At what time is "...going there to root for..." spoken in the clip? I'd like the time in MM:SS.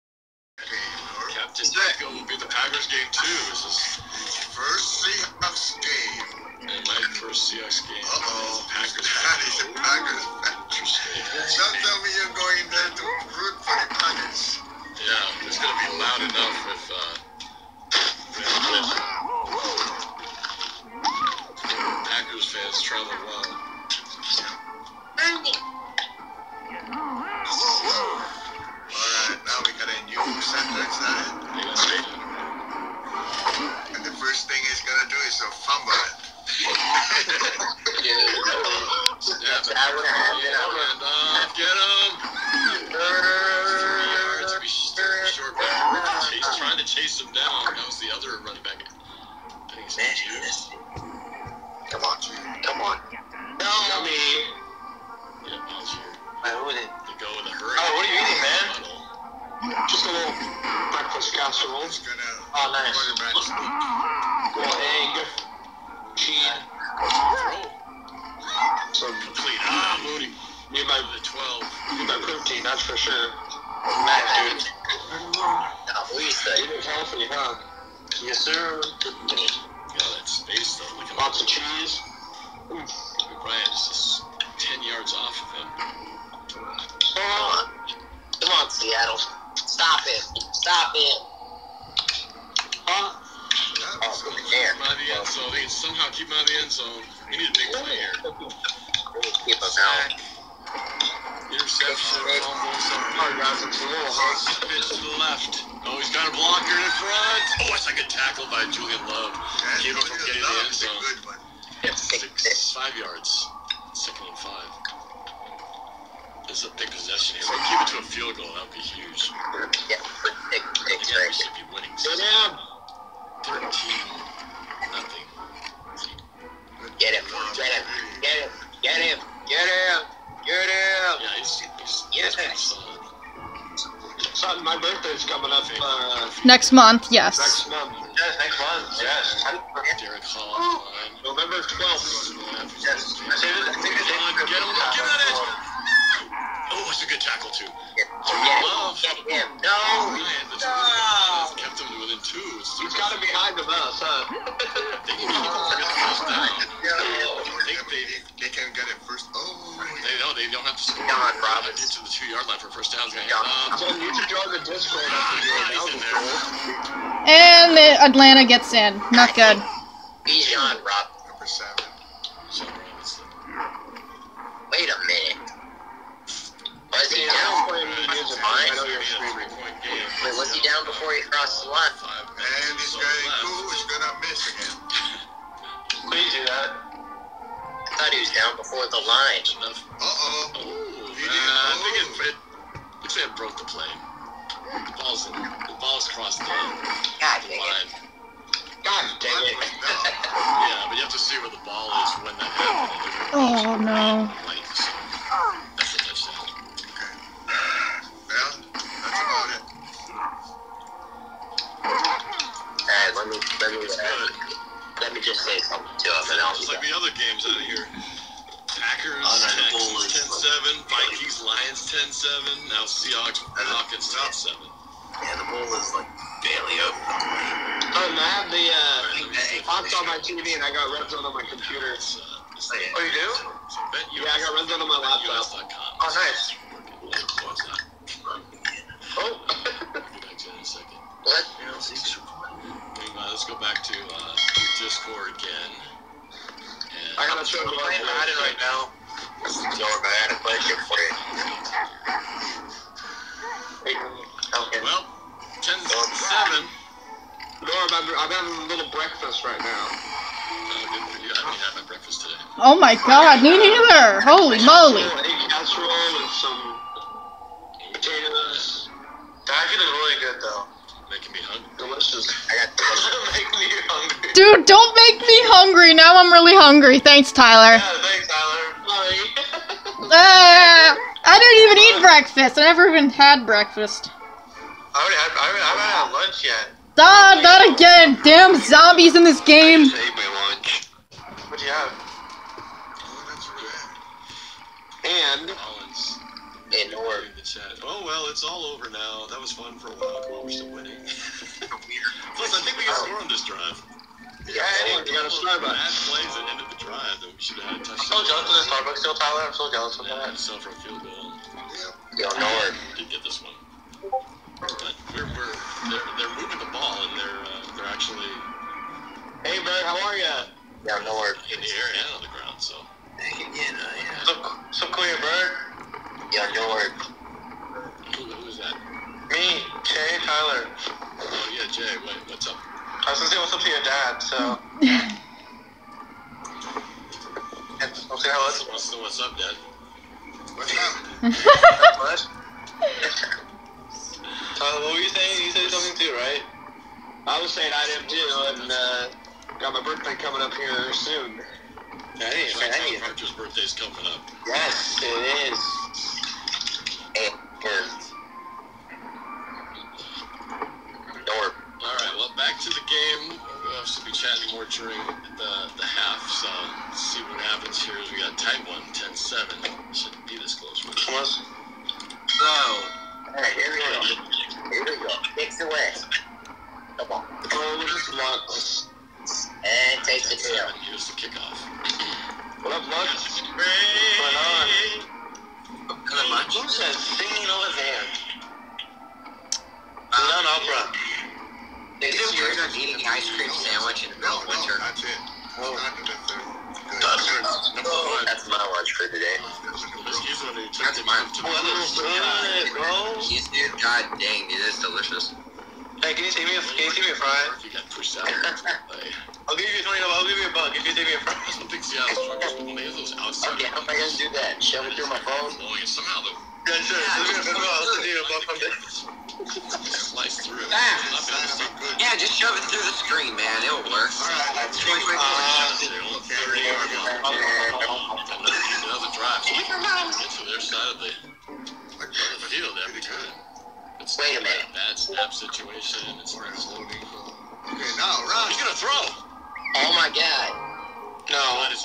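00:12.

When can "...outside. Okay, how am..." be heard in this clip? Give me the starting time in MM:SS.
06:53.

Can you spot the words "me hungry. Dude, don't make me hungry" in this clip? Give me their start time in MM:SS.
04:33.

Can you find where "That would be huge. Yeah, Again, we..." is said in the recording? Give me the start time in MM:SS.
01:58.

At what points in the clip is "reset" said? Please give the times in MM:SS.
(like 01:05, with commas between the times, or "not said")
not said.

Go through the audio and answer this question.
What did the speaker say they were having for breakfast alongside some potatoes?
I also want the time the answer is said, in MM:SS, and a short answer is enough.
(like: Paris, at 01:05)
Egg casserole, at 04:25.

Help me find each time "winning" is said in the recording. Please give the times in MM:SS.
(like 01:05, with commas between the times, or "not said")
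02:01, 05:00.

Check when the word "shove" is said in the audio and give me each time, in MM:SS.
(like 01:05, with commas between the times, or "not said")
06:54, 07:02.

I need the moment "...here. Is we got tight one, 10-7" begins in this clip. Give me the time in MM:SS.
06:07.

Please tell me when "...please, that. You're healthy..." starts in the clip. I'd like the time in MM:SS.
01:16.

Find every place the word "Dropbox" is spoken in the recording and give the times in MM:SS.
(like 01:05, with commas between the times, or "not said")
not said.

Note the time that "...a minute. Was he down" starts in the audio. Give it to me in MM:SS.
02:54.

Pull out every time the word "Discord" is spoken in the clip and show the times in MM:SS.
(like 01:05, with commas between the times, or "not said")
02:44, 04:04.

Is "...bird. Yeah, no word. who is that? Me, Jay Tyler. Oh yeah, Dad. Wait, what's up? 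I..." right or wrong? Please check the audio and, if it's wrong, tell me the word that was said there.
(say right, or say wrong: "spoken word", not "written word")
wrong: "Jay", not "Dad".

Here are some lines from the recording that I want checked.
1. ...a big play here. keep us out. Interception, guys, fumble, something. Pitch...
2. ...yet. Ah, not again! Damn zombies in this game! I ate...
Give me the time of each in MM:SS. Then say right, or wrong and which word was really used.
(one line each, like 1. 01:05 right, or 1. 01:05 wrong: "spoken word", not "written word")
1. 01:37 right
2. 04:46 right.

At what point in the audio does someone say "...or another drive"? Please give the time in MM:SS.
07:06.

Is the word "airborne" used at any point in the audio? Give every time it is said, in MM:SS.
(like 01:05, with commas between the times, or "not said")
not said.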